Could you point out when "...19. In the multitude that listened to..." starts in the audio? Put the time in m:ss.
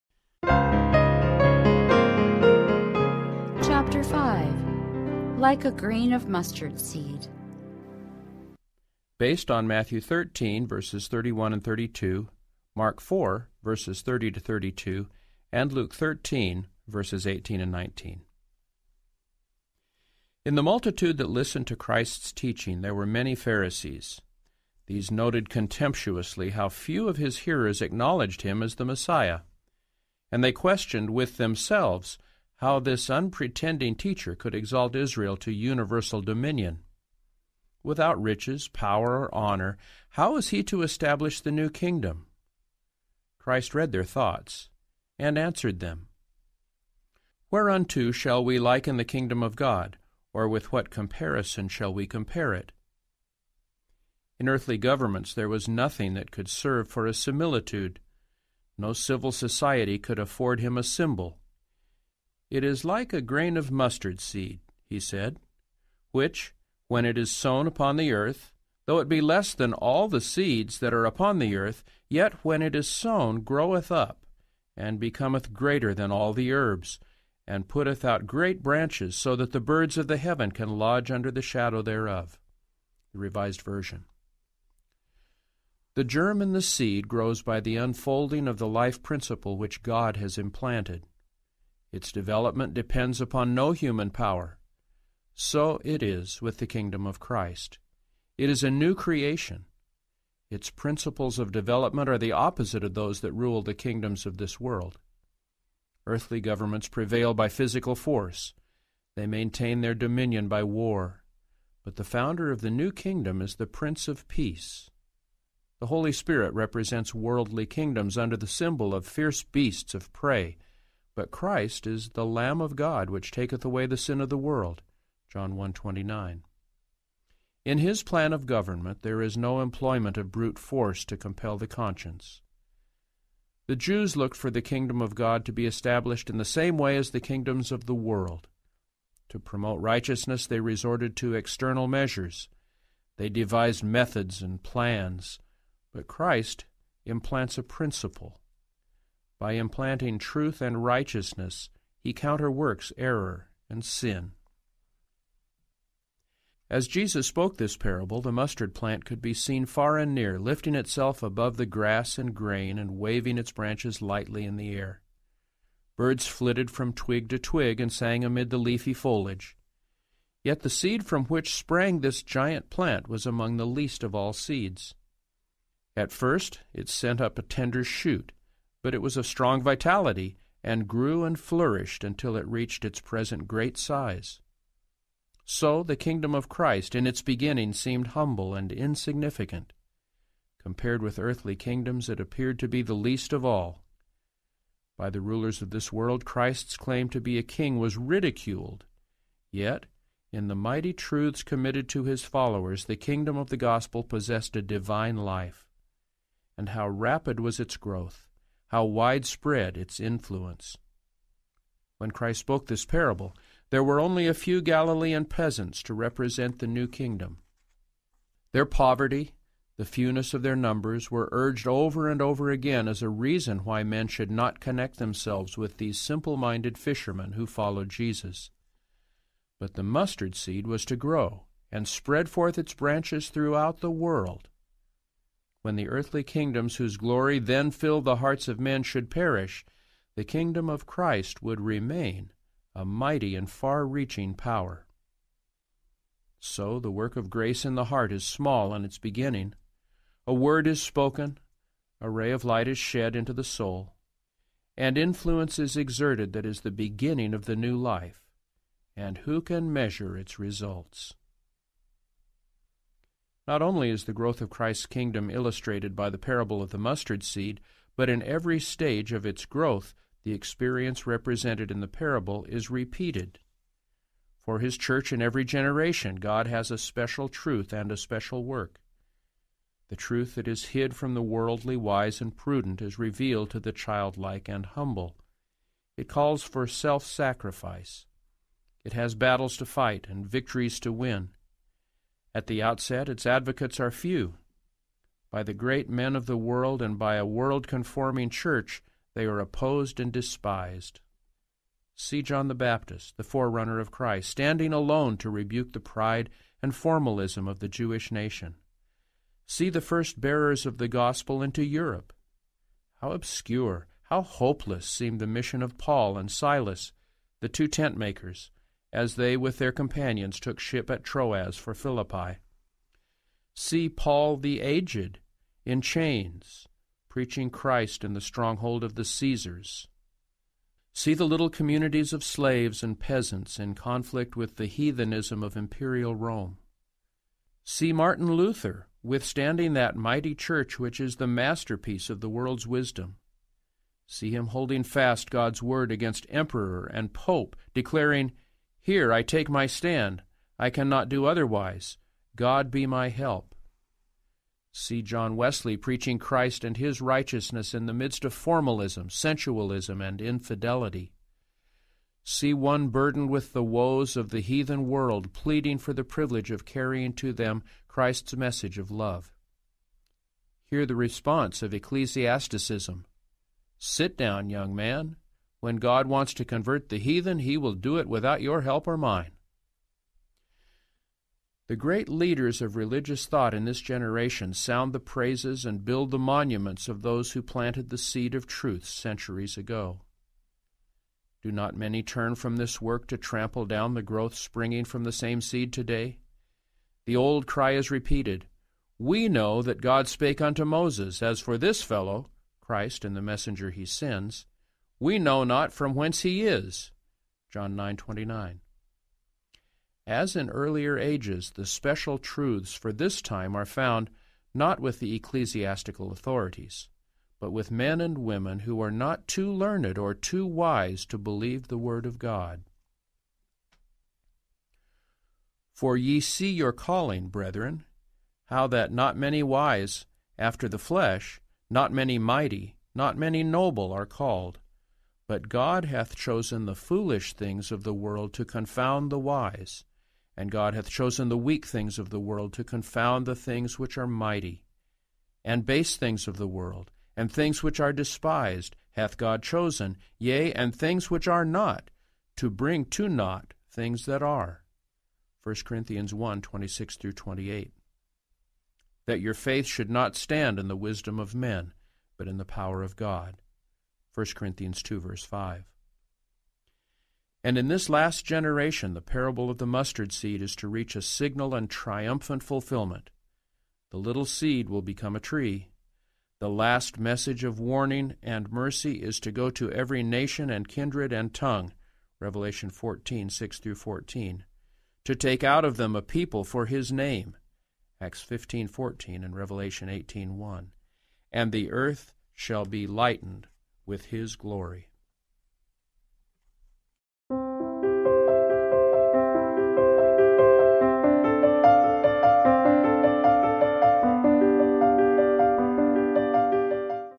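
0:17.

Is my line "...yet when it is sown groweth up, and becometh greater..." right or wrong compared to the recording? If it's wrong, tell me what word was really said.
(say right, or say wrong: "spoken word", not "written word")
right.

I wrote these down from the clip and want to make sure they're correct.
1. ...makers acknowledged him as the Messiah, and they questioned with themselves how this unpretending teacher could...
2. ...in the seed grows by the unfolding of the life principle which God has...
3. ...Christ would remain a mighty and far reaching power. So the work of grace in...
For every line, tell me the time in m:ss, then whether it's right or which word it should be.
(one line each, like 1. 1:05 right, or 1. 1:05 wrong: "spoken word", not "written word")
1. 0:27 wrong: "hearers", not "makers"
2. 1:26 right
3. 4:00 right.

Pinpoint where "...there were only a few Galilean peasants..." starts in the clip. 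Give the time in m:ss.
3:33.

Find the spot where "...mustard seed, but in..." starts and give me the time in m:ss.
4:26.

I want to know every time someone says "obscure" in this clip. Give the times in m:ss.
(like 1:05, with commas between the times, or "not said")
5:13.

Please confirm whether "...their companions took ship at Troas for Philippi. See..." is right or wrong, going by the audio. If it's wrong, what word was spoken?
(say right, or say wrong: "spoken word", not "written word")
right.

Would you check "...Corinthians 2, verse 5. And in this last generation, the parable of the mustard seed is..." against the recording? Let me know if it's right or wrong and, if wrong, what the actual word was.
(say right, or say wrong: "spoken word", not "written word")
right.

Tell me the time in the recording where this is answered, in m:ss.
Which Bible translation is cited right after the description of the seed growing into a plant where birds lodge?
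1:23.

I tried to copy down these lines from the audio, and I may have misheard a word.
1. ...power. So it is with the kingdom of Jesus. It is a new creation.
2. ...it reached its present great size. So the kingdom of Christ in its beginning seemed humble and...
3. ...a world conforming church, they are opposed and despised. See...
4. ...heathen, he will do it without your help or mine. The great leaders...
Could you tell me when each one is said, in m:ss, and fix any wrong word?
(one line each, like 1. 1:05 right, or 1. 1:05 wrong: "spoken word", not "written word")
1. 1:34 wrong: "Christ", not "Jesus"
2. 3:02 right
3. 4:57 right
4. 6:16 right.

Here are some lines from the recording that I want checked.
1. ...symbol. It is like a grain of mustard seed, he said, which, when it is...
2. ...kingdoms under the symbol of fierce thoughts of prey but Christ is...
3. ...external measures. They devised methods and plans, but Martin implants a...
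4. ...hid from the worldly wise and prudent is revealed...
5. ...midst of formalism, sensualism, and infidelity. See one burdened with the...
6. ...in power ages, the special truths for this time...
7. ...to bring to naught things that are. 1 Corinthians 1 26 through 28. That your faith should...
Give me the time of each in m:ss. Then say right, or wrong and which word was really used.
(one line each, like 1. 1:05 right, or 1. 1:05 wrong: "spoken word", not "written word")
1. 1:00 right
2. 1:57 wrong: "beasts", not "thoughts"
3. 2:21 wrong: "Christ", not "Martin"
4. 4:40 right
5. 5:57 right
6. 6:50 wrong: "earlier", not "power"
7. 7:32 right.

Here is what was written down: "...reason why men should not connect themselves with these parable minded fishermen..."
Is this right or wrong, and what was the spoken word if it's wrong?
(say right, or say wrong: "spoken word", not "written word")
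wrong: "simple", not "parable".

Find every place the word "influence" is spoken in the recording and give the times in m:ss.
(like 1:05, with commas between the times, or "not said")
3:29, 4:14.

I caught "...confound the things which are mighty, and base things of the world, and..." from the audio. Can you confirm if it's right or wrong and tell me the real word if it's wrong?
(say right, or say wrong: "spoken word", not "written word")
right.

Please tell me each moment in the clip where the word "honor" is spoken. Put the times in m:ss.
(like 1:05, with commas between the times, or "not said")
0:39.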